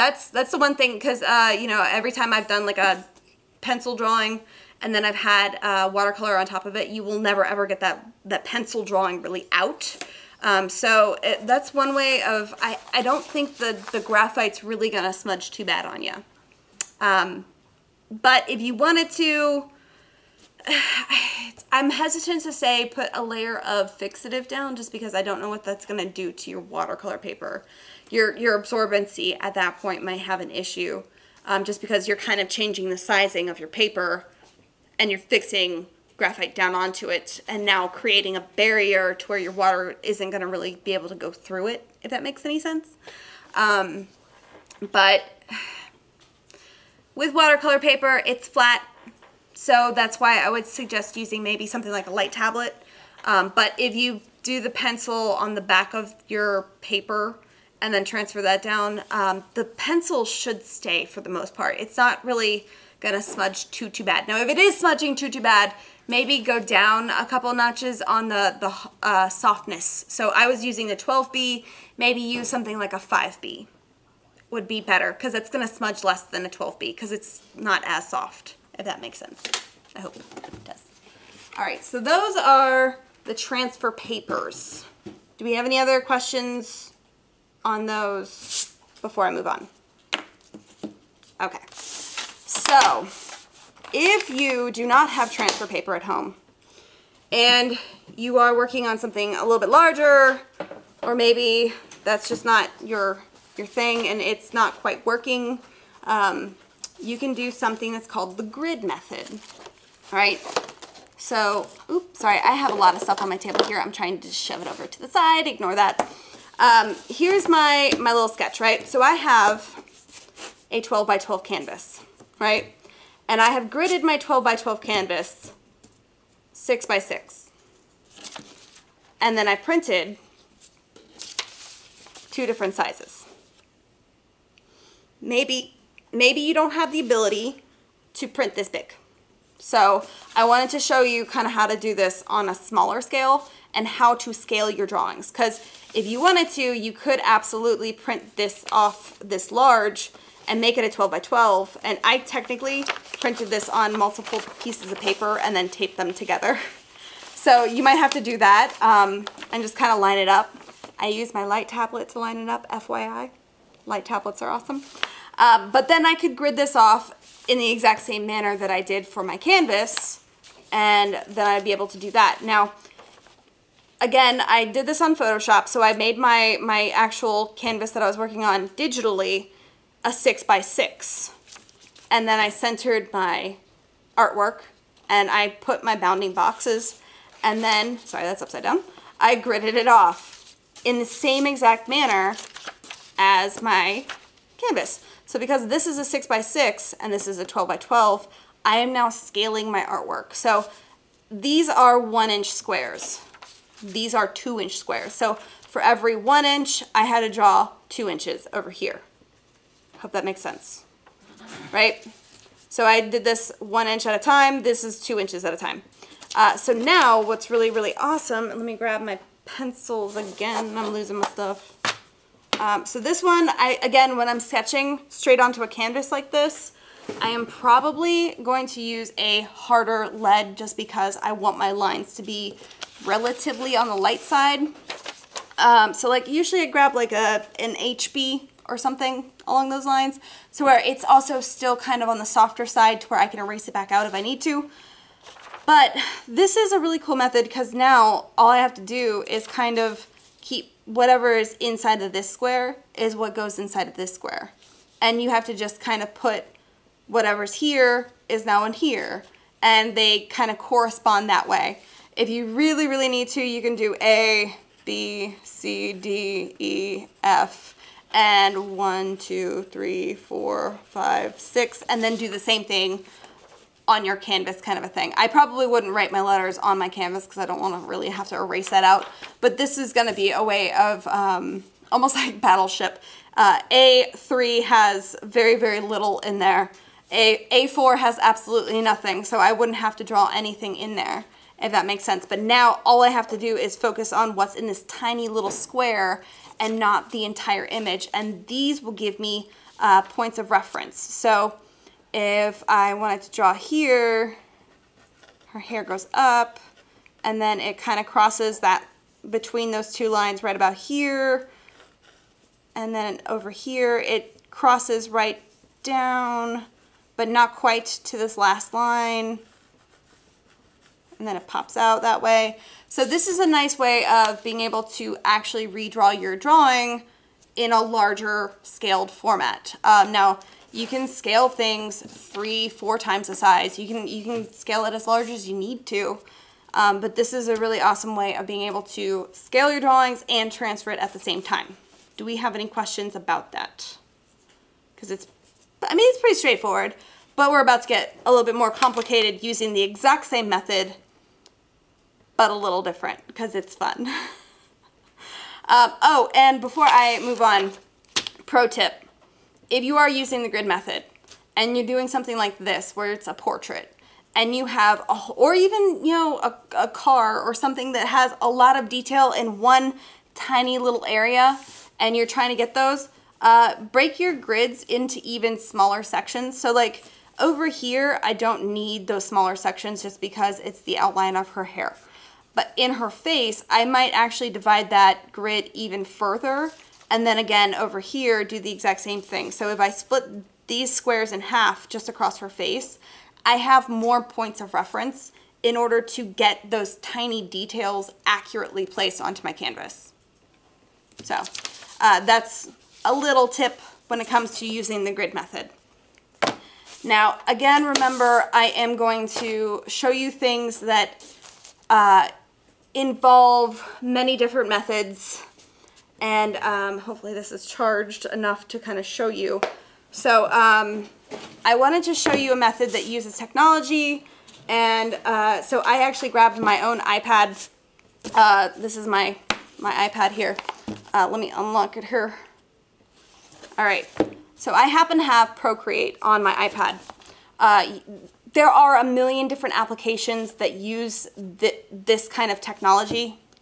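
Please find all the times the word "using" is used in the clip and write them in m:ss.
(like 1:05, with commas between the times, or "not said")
0:51, 1:10, 5:49, 6:00, 6:44.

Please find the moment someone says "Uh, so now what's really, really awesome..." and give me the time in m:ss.
3:36.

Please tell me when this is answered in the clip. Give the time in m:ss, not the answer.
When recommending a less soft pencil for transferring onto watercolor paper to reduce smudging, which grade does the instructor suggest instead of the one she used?
1:12.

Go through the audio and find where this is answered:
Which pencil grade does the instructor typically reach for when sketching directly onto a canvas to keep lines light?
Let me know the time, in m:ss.
3:57.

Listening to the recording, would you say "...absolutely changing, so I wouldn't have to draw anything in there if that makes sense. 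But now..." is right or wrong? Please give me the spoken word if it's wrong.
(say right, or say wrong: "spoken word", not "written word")
wrong: "nothing", not "changing".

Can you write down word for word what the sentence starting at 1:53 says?
I'm trying to shove it over to the side, ignore that.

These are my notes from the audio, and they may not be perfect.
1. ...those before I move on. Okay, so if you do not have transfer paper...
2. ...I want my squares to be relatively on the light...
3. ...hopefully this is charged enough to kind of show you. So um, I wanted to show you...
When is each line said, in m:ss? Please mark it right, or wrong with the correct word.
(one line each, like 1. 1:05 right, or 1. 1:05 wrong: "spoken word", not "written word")
1. 1:27 right
2. 3:51 wrong: "lines", not "squares"
3. 6:56 right.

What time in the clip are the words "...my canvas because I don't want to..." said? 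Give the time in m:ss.
4:36.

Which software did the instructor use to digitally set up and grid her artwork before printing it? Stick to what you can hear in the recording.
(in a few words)
Photoshop.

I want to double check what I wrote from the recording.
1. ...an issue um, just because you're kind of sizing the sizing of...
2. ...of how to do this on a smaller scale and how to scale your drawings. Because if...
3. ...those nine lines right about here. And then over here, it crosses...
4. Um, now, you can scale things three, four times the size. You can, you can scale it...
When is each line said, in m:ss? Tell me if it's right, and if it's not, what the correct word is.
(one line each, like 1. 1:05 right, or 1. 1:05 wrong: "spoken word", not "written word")
1. 0:30 wrong: "changing", not "sizing"
2. 2:21 right
3. 5:09 wrong: "two", not "nine"
4. 5:29 right.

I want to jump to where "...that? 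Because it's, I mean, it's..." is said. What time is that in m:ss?
5:43.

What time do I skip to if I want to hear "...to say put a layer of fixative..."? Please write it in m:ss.
0:22.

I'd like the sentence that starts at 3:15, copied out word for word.
So because this is a six by six and this is a 12 by 12, I am now scaling my artwork.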